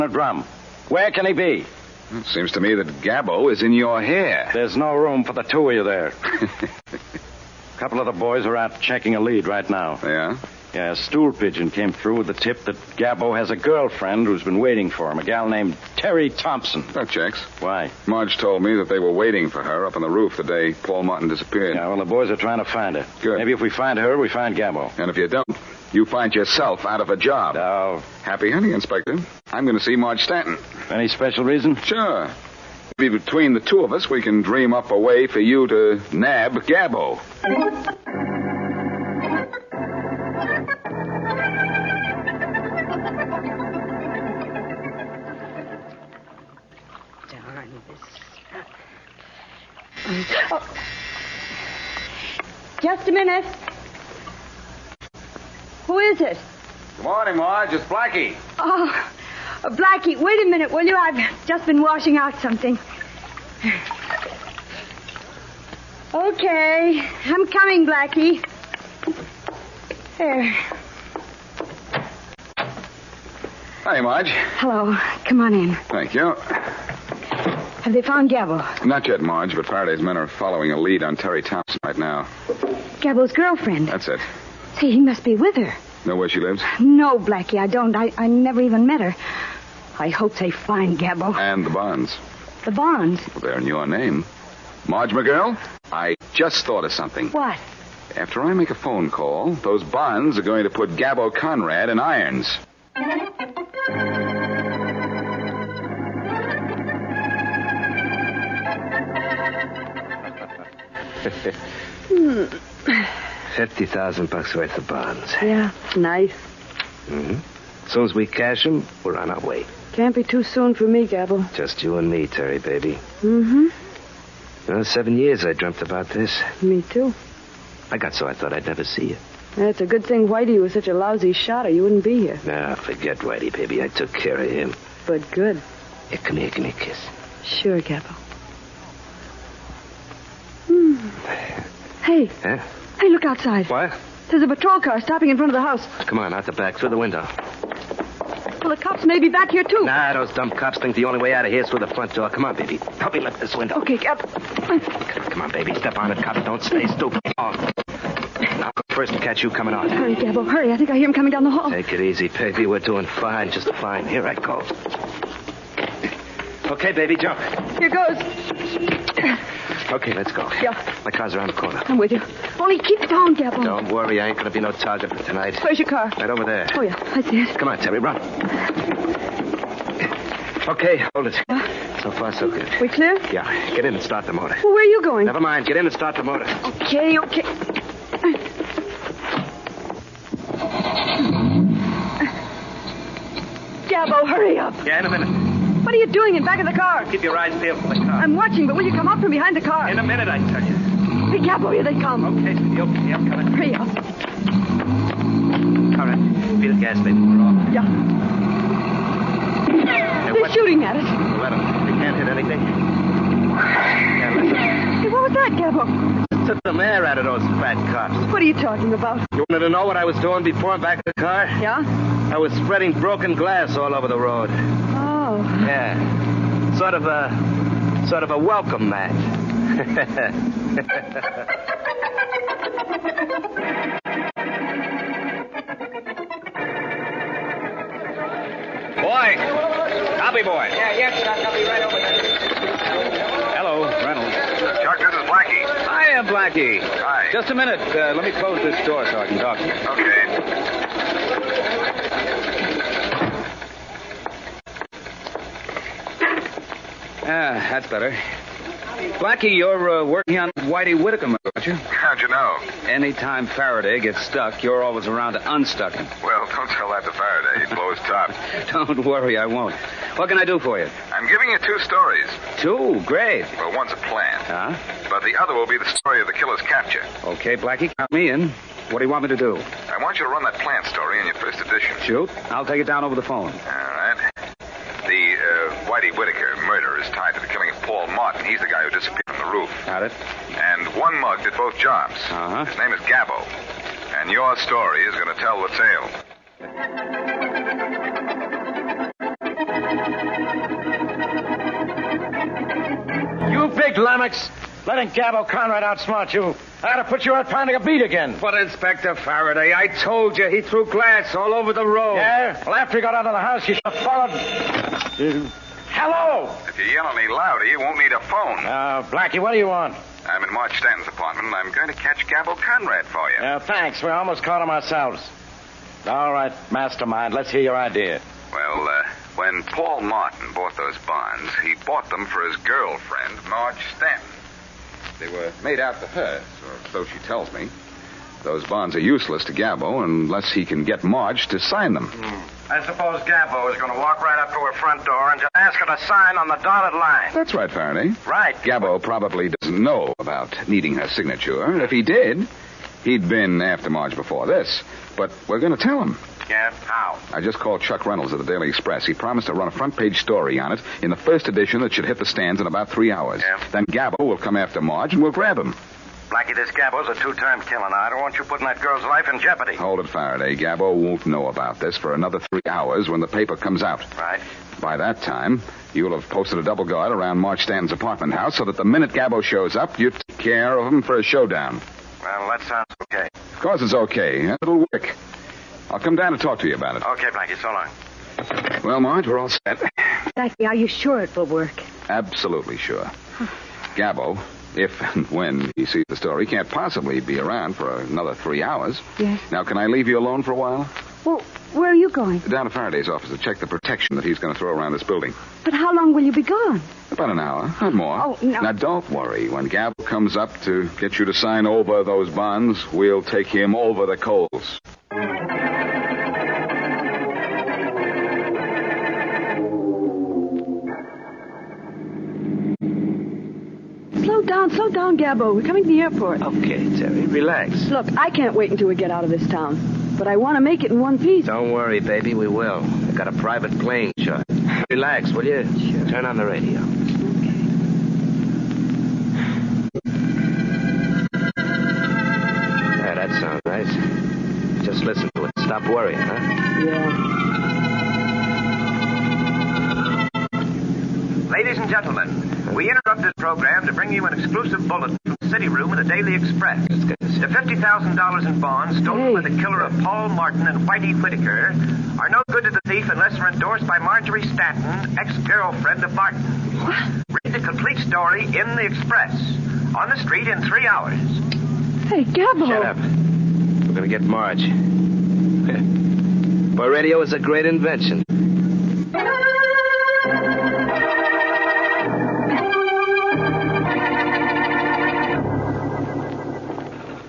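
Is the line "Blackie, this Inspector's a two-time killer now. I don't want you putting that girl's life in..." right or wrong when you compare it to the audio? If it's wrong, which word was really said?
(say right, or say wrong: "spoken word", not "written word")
wrong: "Gabbo", not "Inspector".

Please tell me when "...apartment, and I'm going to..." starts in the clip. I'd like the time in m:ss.
5:21.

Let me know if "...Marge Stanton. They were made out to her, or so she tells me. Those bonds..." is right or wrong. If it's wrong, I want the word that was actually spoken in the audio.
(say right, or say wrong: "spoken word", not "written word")
right.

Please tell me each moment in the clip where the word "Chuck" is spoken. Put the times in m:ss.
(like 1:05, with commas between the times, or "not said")
4:04, 5:57.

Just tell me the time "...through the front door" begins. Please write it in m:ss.
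2:31.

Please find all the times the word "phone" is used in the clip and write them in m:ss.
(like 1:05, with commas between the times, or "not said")
1:38, 4:43, 5:18.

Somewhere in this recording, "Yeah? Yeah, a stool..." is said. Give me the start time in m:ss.
0:10.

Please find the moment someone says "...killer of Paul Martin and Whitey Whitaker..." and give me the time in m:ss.
7:39.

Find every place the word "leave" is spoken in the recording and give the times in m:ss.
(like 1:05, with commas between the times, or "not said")
6:39.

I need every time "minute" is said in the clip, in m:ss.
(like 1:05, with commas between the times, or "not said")
0:53, 1:00, 3:15, 3:20, 4:07, 6:18.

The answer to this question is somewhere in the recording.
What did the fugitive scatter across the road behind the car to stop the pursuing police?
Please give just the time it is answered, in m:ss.
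3:42.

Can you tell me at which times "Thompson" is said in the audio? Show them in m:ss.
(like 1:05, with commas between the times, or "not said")
0:16, 1:21.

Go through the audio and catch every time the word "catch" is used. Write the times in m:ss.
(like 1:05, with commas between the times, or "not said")
2:39, 5:21.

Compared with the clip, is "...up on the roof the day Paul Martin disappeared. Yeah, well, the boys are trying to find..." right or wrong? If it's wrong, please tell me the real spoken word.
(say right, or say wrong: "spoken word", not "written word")
right.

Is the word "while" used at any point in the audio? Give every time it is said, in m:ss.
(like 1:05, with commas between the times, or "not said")
6:40.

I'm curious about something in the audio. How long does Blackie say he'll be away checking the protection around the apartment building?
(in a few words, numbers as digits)
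About an hour.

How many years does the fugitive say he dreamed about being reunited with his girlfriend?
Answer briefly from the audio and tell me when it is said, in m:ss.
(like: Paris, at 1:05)
7, at 2:04.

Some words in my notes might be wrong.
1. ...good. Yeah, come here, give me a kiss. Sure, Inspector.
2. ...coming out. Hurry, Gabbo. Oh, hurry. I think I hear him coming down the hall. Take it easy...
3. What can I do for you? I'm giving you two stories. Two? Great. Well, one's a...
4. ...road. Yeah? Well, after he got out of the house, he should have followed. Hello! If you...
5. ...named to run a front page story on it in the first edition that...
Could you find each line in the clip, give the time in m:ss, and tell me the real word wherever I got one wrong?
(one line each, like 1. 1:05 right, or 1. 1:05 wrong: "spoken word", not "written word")
1. 2:15 wrong: "Gabbo", not "Inspector"
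2. 2:39 right
3. 4:30 right
4. 5:11 right
5. 5:59 wrong: "promised", not "named".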